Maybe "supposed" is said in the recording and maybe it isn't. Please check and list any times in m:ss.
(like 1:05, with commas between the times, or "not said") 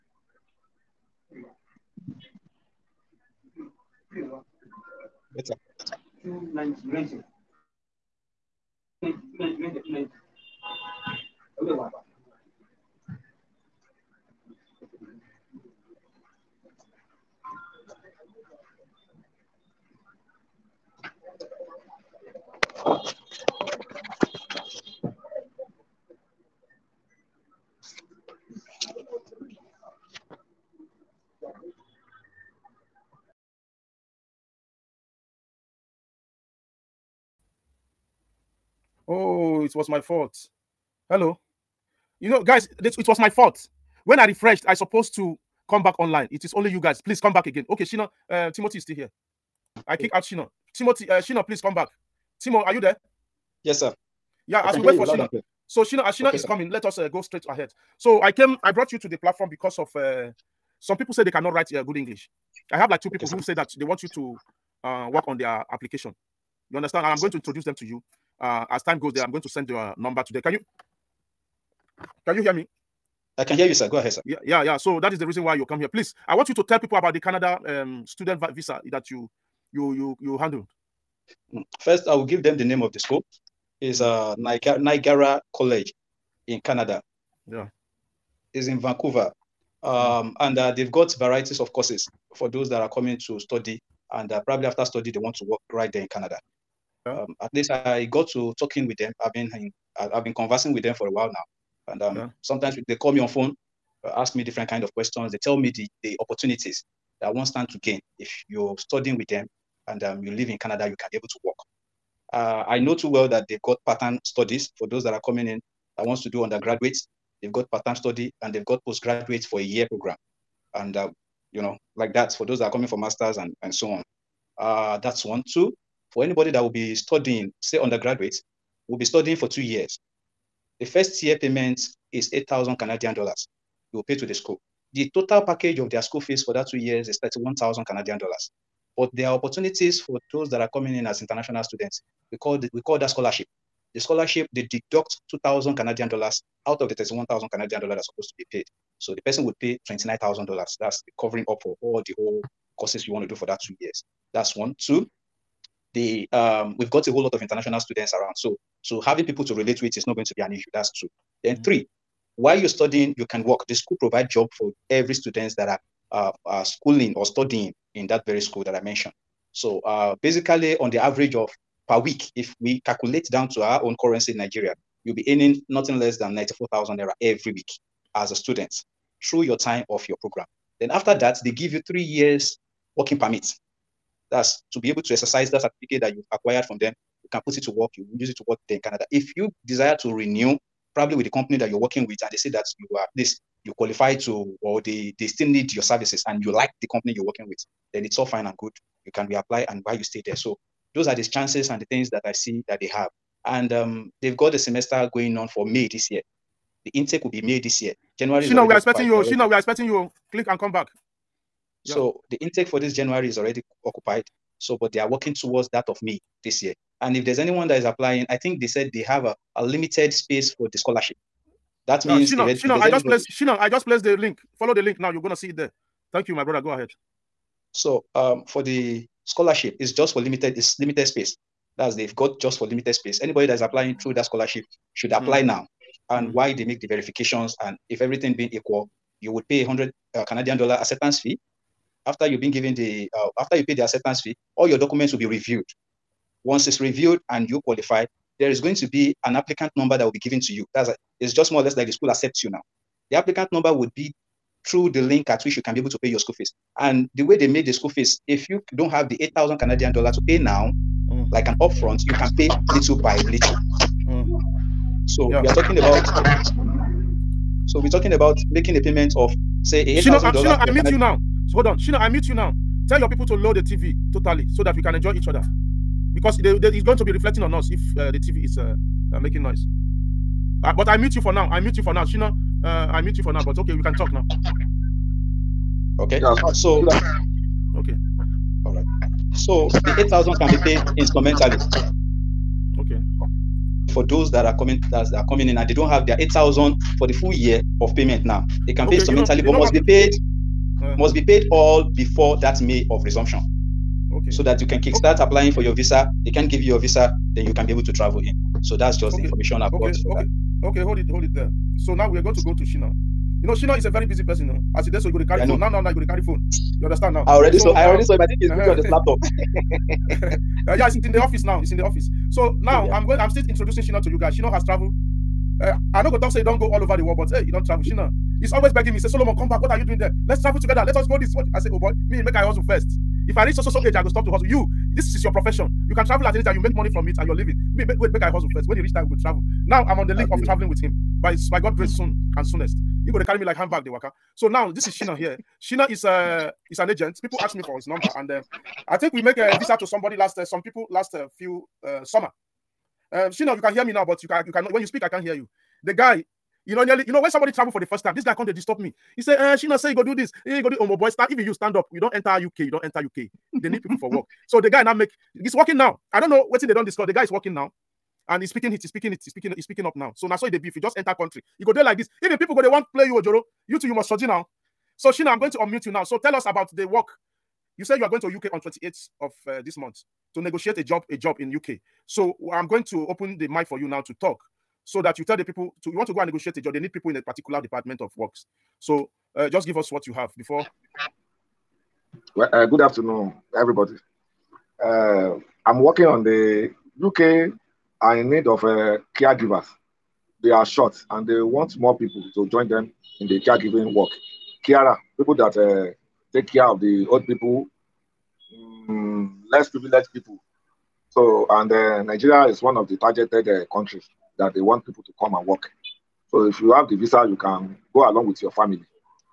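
0:44, 2:28.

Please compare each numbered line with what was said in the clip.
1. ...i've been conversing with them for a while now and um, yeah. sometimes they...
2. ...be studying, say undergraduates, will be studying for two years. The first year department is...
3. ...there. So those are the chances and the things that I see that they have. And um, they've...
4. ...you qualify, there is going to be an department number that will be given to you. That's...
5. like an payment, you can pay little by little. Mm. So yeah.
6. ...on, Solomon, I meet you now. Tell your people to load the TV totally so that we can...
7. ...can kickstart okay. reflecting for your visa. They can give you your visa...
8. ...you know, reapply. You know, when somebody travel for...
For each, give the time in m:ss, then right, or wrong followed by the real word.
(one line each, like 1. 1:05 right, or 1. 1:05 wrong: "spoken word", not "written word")
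1. 1:39 right
2. 2:06 wrong: "payment", not "department"
3. 3:20 right
4. 4:07 wrong: "applicant", not "department"
5. 4:21 wrong: "upfront", not "payment"
6. 4:31 wrong: "Shino", not "Solomon"
7. 5:04 wrong: "applying", not "reflecting"
8. 5:56 wrong: "nearly", not "reapply".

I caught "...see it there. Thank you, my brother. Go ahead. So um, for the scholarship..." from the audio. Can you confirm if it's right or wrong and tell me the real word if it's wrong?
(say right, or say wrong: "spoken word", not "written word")
right.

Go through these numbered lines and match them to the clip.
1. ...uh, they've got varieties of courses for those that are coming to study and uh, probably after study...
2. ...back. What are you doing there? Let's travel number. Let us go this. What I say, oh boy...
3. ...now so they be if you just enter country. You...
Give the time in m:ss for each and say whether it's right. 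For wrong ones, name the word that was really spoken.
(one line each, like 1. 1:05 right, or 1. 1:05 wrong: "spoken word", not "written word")
1. 1:30 right
2. 5:29 wrong: "together", not "number"
3. 6:10 right.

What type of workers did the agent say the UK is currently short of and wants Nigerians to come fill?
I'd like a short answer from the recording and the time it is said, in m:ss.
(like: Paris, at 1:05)
Caregivers, at 6:39.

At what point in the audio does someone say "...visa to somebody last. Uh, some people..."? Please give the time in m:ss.
5:49.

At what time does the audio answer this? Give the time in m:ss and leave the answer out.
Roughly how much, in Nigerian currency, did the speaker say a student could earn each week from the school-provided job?
2:56.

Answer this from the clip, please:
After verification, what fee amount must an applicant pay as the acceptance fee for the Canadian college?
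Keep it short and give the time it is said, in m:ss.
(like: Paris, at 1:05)
100 Canadian dollars, at 3:59.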